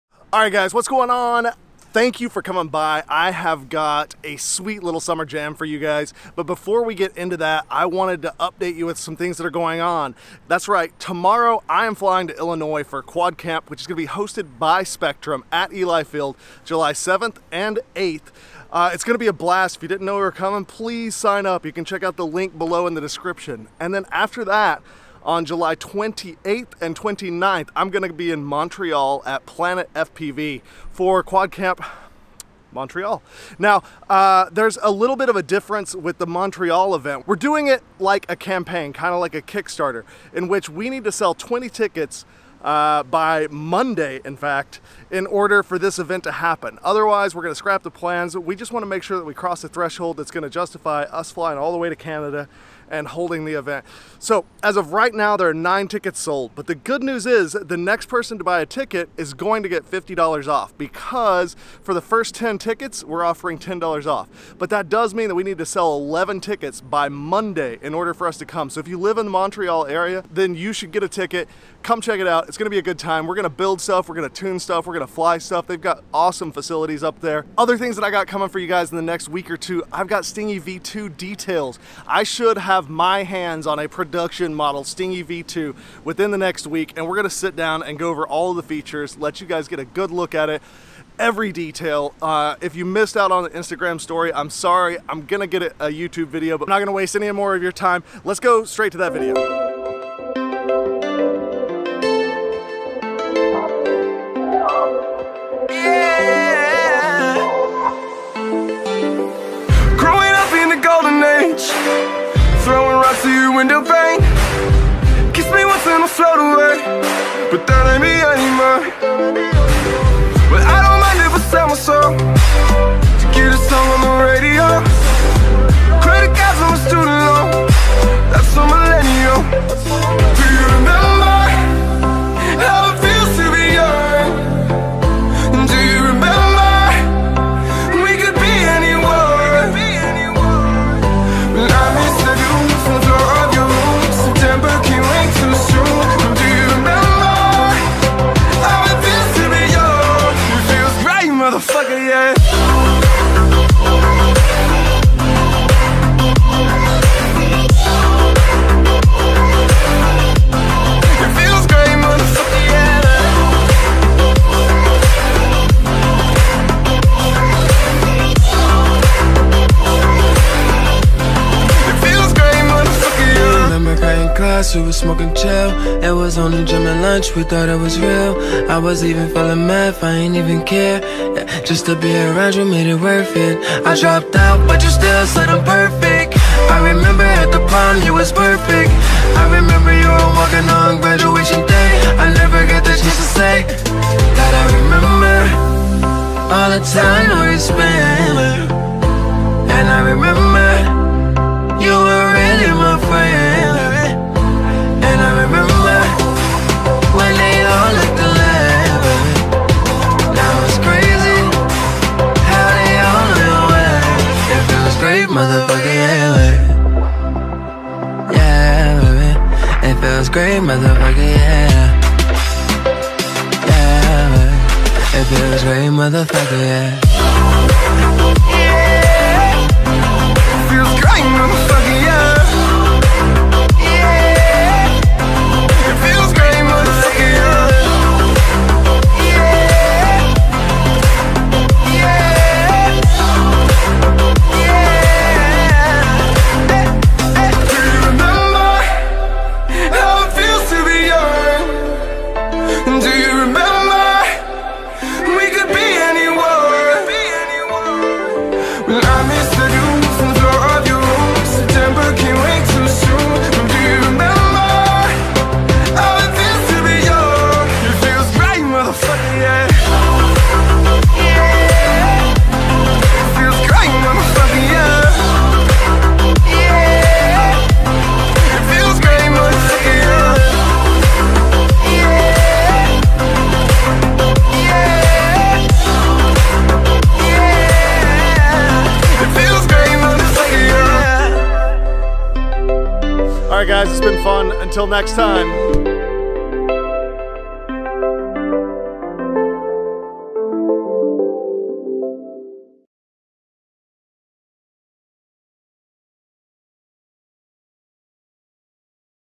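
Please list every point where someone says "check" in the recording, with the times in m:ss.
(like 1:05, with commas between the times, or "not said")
0:21, 1:12.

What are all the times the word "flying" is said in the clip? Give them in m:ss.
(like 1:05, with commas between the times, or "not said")
0:11, 0:51.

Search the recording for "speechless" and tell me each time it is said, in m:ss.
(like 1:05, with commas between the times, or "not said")
not said.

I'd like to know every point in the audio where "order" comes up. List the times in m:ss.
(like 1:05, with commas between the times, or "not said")
0:45, 1:07.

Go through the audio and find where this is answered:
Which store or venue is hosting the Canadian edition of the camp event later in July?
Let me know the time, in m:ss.
0:29.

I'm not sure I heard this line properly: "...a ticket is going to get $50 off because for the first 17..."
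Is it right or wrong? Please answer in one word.
wrong.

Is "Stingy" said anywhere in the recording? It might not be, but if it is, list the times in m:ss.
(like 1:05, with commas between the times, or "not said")
1:20, 1:24.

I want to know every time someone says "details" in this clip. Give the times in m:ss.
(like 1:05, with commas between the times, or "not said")
1:21, 1:31.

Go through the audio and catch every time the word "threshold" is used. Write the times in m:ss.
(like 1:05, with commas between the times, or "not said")
0:49.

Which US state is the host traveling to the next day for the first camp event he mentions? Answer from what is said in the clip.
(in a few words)
Illinois.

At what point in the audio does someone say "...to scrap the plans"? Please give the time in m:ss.
0:47.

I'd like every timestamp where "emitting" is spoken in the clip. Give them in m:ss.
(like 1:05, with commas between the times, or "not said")
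not said.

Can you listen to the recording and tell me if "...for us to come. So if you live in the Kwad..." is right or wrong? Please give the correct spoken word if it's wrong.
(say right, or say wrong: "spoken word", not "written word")
wrong: "Montreal", not "Kwad".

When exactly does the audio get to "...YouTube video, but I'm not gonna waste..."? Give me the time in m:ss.
1:35.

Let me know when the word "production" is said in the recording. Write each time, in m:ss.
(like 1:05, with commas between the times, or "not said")
1:23.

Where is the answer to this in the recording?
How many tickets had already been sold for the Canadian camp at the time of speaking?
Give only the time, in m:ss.
0:55.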